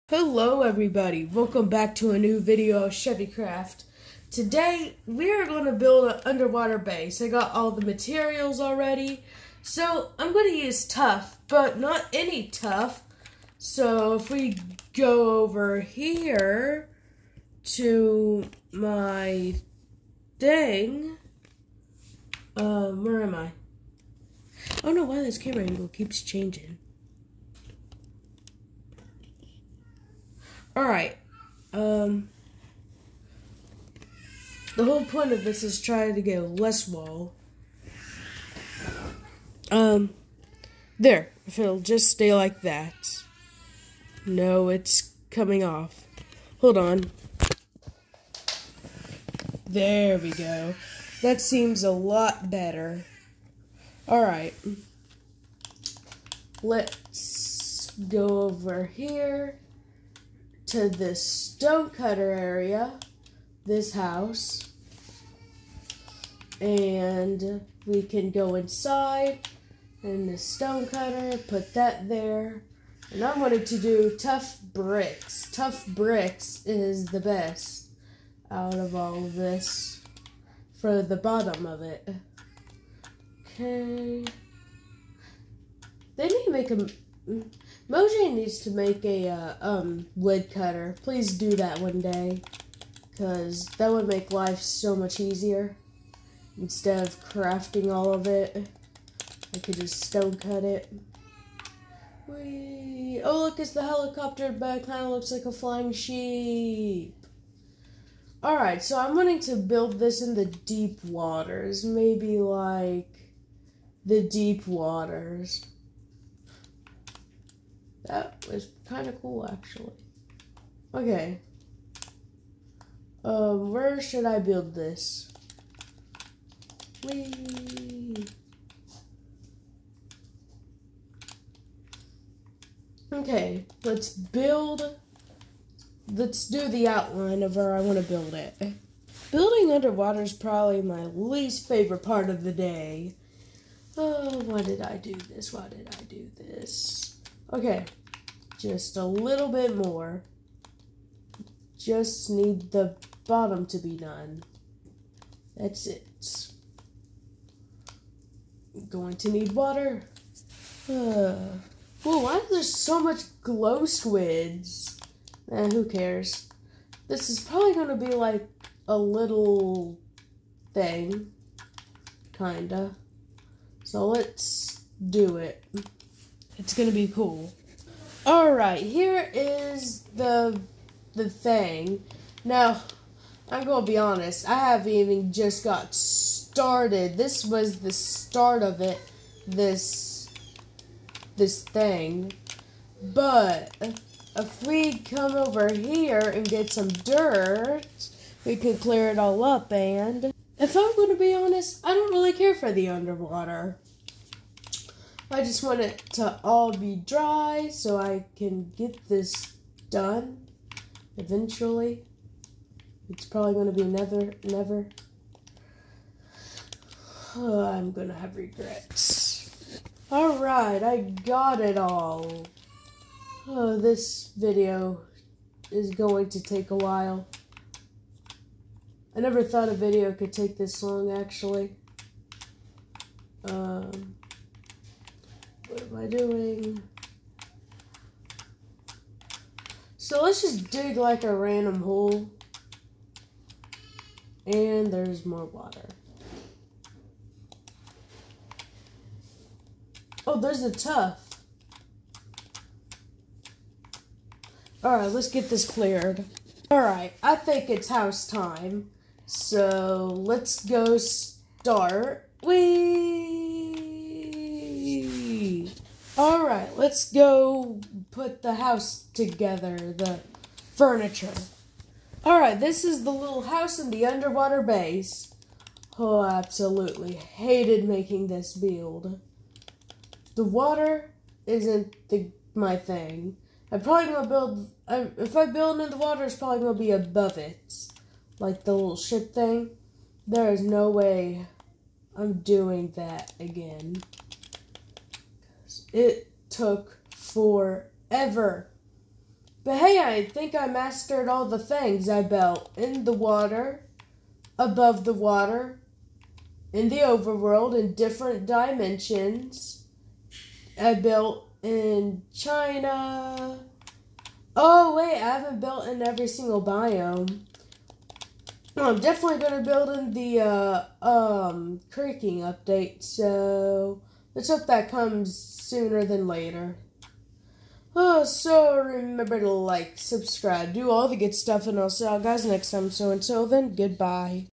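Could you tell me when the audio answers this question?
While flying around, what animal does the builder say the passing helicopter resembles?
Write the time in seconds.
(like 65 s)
105 s.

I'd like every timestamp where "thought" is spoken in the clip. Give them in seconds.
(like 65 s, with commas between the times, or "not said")
229 s.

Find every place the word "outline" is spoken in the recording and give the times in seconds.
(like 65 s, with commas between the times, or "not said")
136 s.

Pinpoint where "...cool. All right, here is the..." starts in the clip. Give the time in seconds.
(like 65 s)
177 s.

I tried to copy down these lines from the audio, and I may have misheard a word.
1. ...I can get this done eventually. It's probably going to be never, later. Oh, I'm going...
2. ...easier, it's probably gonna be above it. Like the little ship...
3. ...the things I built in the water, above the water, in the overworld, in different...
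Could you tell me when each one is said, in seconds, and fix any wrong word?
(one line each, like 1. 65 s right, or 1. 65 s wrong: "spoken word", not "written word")
1. 207 s wrong: "never", not "later"
2. 285 s wrong: "water", not "easier"
3. 301 s right.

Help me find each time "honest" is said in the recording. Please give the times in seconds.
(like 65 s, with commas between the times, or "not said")
183 s, 201 s.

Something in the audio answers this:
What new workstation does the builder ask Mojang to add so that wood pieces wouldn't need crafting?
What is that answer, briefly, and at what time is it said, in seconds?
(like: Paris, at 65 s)
Wood cutter, at 90 s.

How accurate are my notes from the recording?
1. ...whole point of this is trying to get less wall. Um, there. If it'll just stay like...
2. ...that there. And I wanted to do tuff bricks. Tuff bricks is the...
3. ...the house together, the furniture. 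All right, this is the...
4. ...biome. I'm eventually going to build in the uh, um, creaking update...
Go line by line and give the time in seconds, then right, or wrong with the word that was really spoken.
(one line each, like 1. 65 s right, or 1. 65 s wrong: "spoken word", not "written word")
1. 34 s right
2. 71 s right
3. 268 s right
4. 316 s wrong: "definitely", not "eventually".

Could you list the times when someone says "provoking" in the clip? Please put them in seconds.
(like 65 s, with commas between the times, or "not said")
not said.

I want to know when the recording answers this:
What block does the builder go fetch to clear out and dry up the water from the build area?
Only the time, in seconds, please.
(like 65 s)
196 s.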